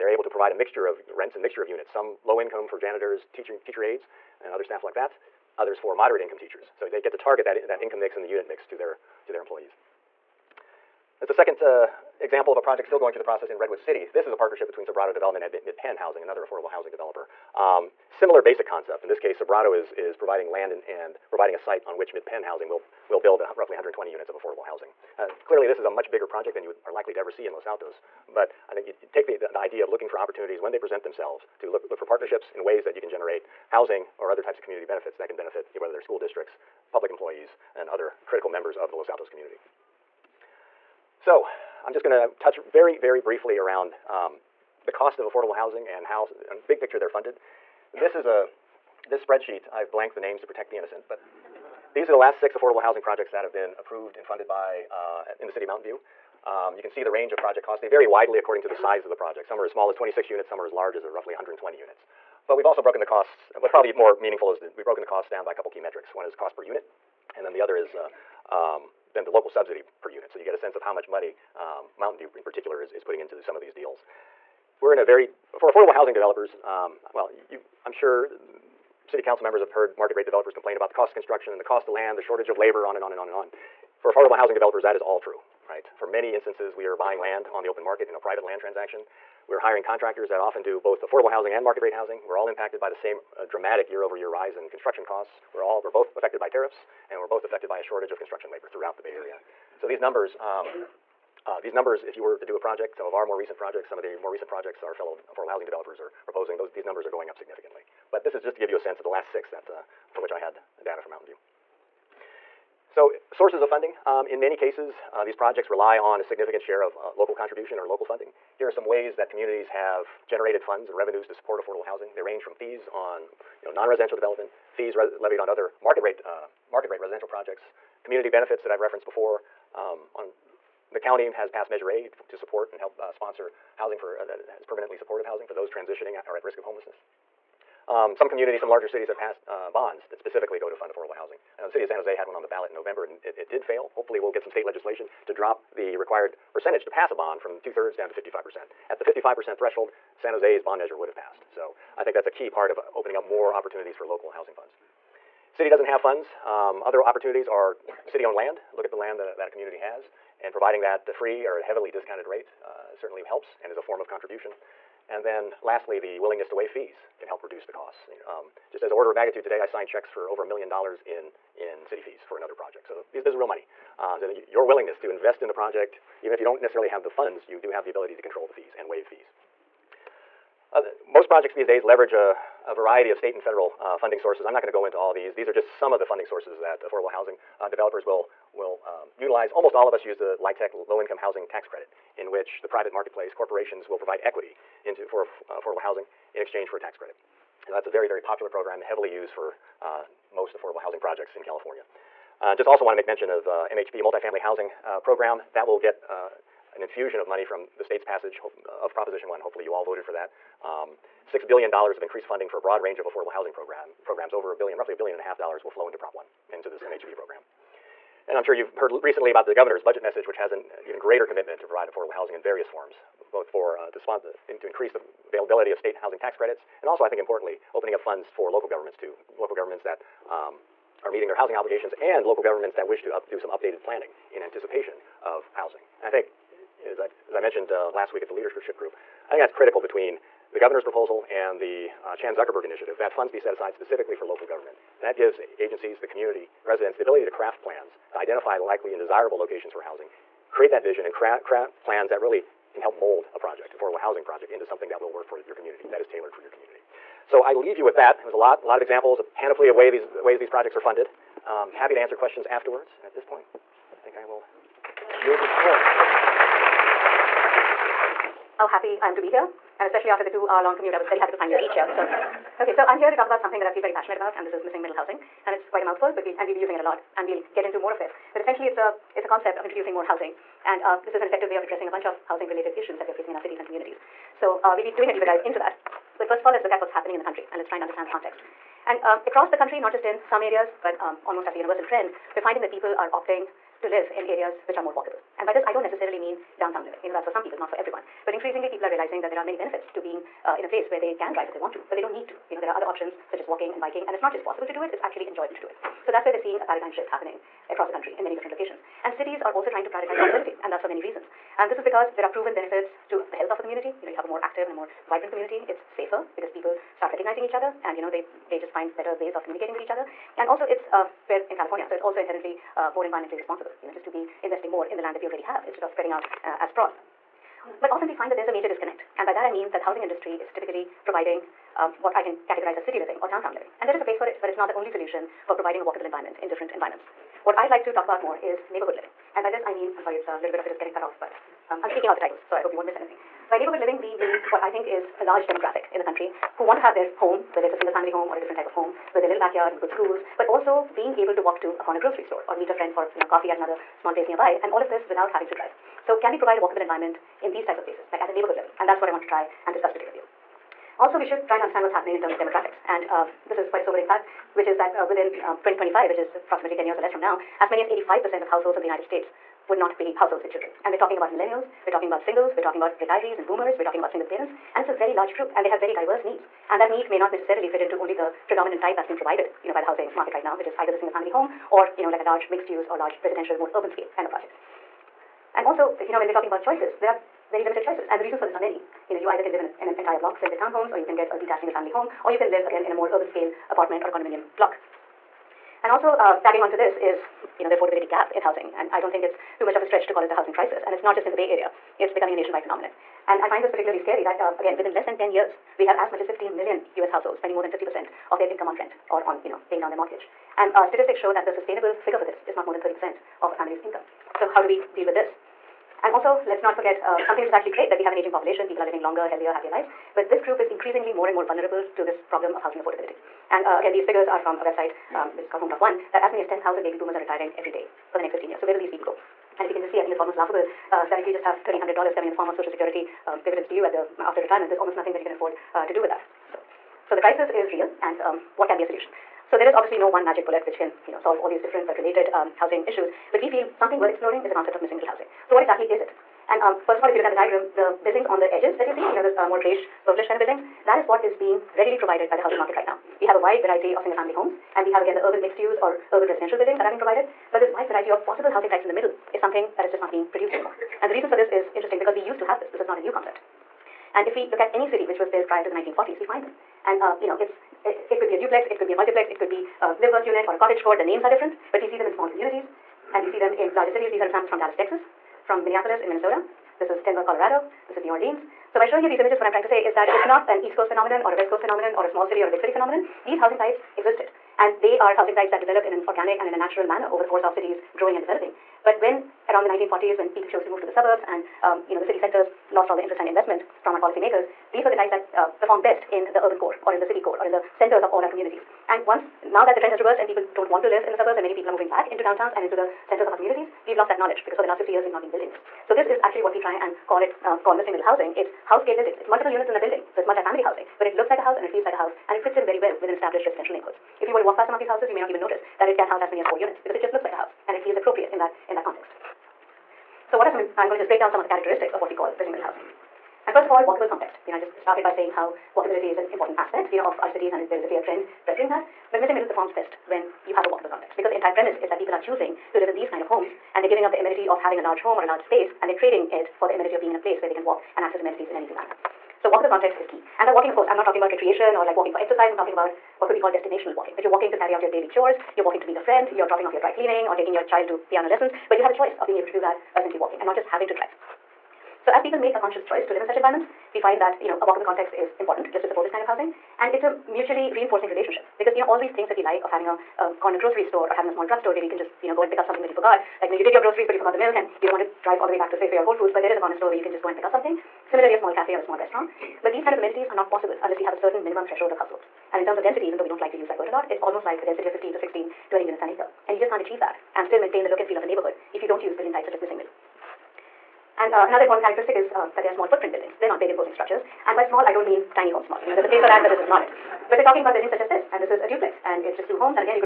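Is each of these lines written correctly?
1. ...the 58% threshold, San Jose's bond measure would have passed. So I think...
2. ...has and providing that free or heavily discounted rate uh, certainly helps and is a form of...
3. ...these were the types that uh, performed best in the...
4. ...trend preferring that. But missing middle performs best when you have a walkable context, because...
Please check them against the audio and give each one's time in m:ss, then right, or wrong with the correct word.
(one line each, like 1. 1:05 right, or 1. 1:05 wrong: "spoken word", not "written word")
1. 2:28 wrong: "55", not "58"
2. 2:39 right
3. 8:14 right
4. 8:48 right.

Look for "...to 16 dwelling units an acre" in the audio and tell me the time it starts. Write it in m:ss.
9:35.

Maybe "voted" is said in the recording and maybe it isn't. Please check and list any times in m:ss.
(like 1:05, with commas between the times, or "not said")
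3:29.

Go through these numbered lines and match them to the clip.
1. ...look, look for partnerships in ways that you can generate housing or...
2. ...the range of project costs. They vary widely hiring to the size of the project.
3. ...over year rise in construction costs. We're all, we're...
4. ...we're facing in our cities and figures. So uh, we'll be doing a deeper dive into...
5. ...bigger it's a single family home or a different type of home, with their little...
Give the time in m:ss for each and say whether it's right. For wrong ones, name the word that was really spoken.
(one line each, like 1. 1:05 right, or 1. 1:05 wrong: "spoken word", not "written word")
1. 0:31 right
2. 0:57 wrong: "according", not "hiring"
3. 1:34 right
4. 4:43 wrong: "communities", not "figures"
5. 5:47 wrong: "whether", not "bigger".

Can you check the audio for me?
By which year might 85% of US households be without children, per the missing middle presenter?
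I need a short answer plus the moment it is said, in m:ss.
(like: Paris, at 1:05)
2025, at 6:05.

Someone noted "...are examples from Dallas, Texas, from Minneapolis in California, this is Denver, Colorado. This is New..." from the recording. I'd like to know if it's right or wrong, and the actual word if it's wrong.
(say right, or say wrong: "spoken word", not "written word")
wrong: "Minnesota", not "California".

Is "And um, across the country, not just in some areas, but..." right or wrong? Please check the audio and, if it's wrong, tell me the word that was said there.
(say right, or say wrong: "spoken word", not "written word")
right.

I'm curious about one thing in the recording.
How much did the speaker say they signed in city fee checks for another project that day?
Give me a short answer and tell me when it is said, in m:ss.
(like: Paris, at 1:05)
over a million dollars, at 2:50.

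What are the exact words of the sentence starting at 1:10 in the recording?
So you get a sense of how much money um, Mountain View in particular is, is putting into some of these deals.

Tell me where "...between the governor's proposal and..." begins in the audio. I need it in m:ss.
3:59.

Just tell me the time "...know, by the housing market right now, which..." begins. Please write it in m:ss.
6:19.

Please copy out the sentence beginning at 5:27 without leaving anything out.
But often we find that there's a major disconnect.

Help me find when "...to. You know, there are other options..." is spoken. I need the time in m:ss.
5:02.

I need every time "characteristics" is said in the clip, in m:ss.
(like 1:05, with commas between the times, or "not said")
8:41, 9:41.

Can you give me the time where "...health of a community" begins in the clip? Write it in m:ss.
5:13.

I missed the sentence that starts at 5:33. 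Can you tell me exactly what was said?
And there is a place for it, but it's not the only solution for providing a walkable environment in different environments.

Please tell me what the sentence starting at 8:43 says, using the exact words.
And first of all, walkable context.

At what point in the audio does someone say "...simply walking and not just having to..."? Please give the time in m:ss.
9:10.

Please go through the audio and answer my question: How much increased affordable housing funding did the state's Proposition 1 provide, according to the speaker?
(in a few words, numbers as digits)
$6 billion.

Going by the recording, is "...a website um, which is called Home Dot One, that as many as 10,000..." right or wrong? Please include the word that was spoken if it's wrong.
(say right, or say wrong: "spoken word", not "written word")
right.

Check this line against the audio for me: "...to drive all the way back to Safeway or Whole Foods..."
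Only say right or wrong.
right.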